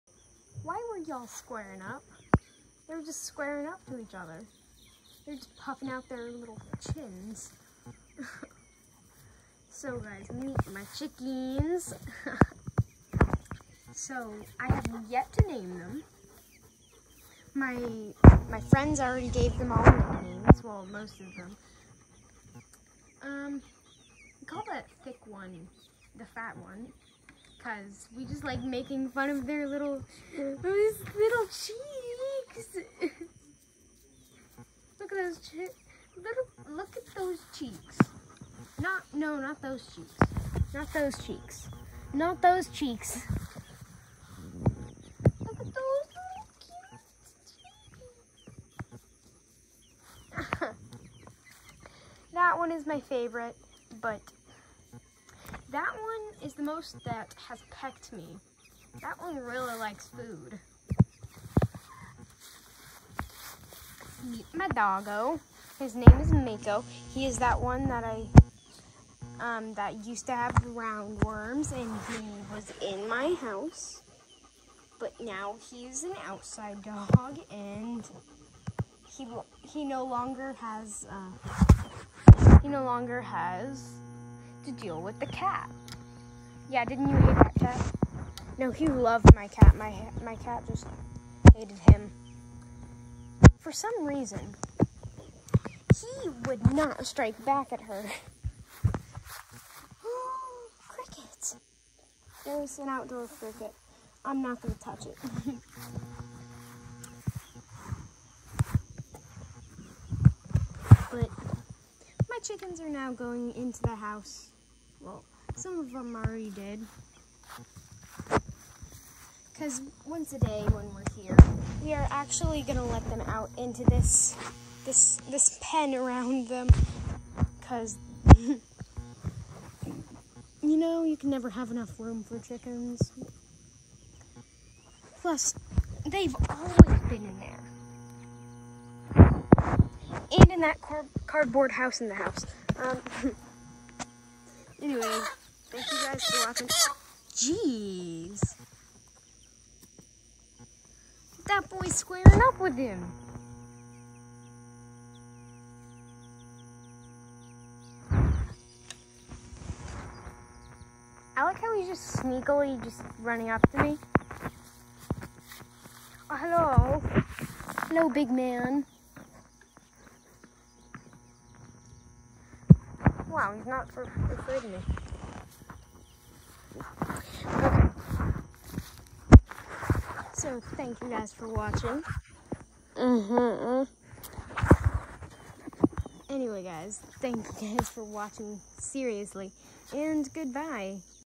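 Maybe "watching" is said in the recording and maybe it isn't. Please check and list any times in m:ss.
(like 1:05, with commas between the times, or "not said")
2:26, 3:01, 3:08.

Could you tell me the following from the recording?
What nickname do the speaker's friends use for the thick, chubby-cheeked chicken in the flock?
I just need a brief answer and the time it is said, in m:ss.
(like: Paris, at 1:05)
the fat one, at 0:26.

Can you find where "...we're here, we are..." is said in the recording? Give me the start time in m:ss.
2:00.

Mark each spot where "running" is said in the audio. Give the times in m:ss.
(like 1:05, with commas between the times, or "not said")
2:43.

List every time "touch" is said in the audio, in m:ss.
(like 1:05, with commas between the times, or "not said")
1:44.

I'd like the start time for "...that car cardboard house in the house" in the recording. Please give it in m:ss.
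2:20.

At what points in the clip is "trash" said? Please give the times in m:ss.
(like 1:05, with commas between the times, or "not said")
not said.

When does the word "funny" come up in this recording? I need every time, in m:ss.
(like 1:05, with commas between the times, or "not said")
not said.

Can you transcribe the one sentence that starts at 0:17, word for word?
My my friends already gave them all names.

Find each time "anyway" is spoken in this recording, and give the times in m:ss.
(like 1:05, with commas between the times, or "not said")
2:24, 3:06.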